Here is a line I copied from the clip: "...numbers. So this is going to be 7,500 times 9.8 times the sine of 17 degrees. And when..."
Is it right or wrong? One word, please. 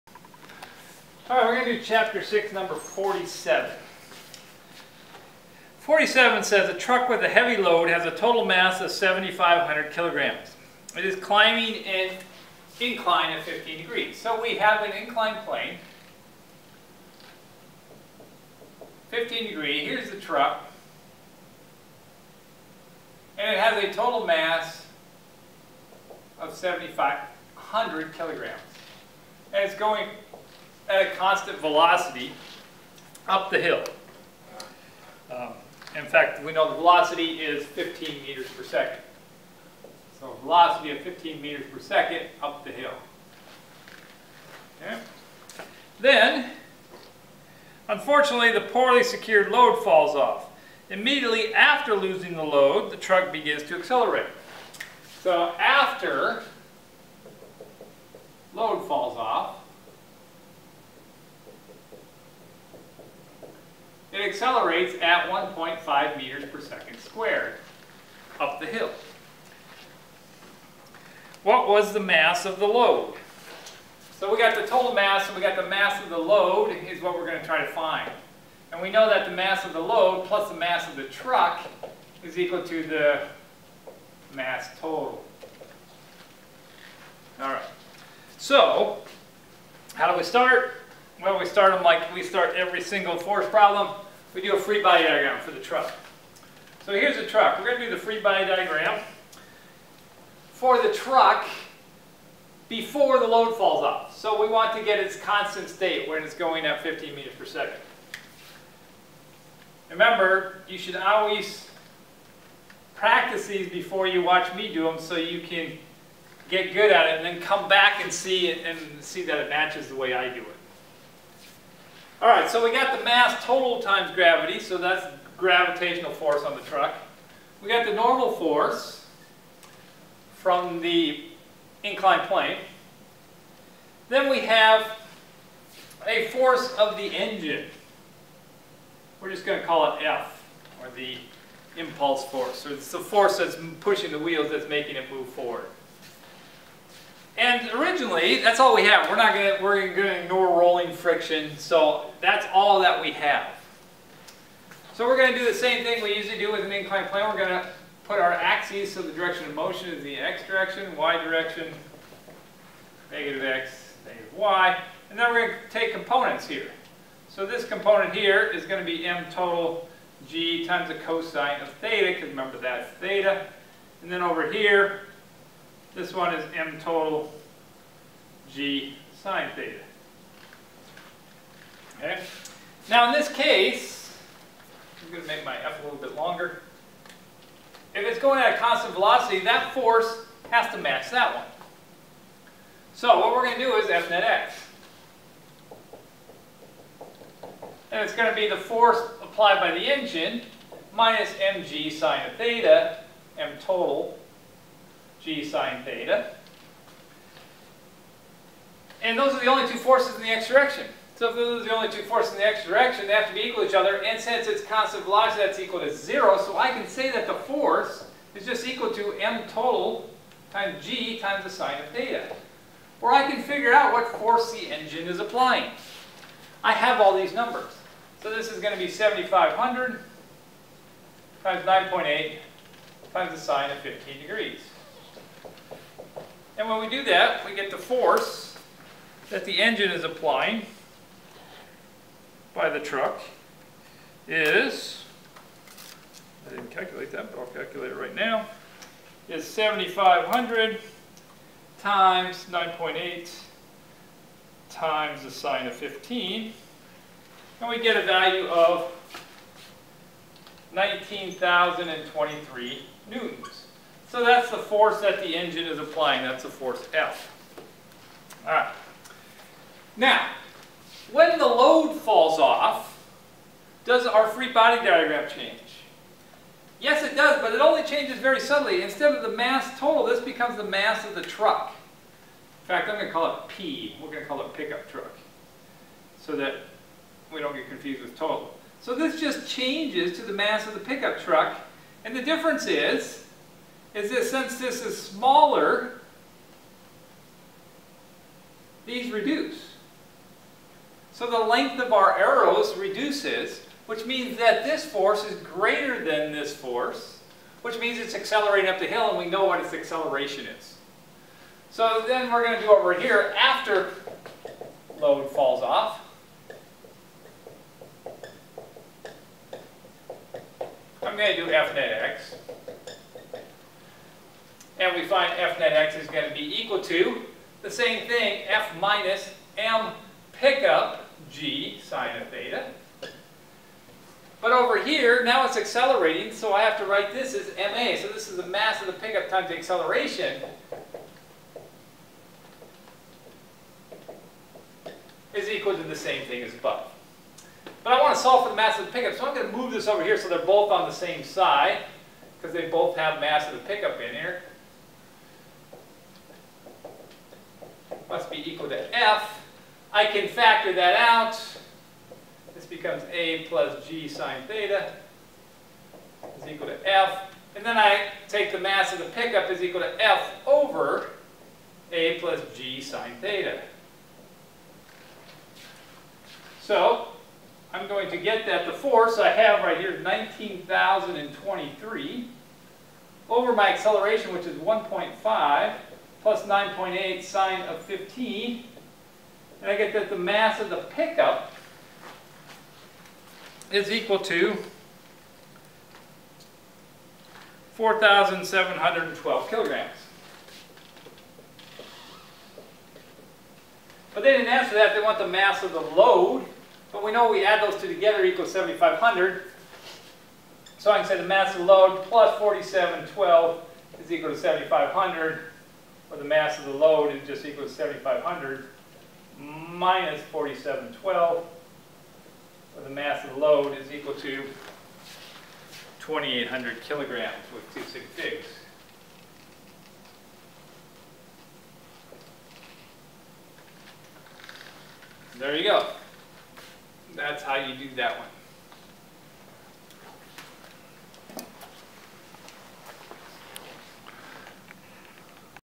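wrong.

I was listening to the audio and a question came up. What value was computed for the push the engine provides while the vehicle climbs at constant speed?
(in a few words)
19,023 newtons.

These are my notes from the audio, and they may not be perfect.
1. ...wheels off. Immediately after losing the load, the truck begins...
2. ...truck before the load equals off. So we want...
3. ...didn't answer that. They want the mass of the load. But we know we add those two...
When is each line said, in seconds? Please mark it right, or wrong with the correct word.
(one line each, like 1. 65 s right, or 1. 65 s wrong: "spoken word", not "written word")
1. 49 s wrong: "falls", not "wheels"
2. 100 s wrong: "falls", not "equals"
3. 404 s right.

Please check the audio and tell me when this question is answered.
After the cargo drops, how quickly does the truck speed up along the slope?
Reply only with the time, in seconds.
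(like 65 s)
65 s.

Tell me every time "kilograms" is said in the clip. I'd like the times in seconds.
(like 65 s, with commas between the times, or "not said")
9 s, 28 s, 399 s, 426 s.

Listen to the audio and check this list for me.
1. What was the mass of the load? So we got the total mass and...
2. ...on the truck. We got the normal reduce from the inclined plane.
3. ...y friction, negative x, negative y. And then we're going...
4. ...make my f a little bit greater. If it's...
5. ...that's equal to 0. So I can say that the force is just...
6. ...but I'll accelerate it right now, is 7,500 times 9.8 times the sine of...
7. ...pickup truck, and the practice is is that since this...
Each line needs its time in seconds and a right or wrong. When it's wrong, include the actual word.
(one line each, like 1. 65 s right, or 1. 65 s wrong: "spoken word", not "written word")
1. 71 s right
2. 126 s wrong: "force", not "reduce"
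3. 160 s wrong: "direction", not "friction"
4. 185 s wrong: "longer", not "greater"
5. 215 s right
6. 247 s wrong: "calculate", not "accelerate"
7. 290 s wrong: "difference", not "practice".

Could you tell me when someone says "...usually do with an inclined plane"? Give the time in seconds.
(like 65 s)
156 s.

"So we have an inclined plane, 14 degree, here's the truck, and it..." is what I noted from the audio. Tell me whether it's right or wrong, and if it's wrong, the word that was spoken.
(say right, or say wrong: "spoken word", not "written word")
wrong: "15", not "14".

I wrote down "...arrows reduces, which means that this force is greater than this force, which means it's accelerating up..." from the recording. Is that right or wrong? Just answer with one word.
right.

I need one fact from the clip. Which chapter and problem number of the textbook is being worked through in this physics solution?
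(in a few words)
Chapter 6, number 47.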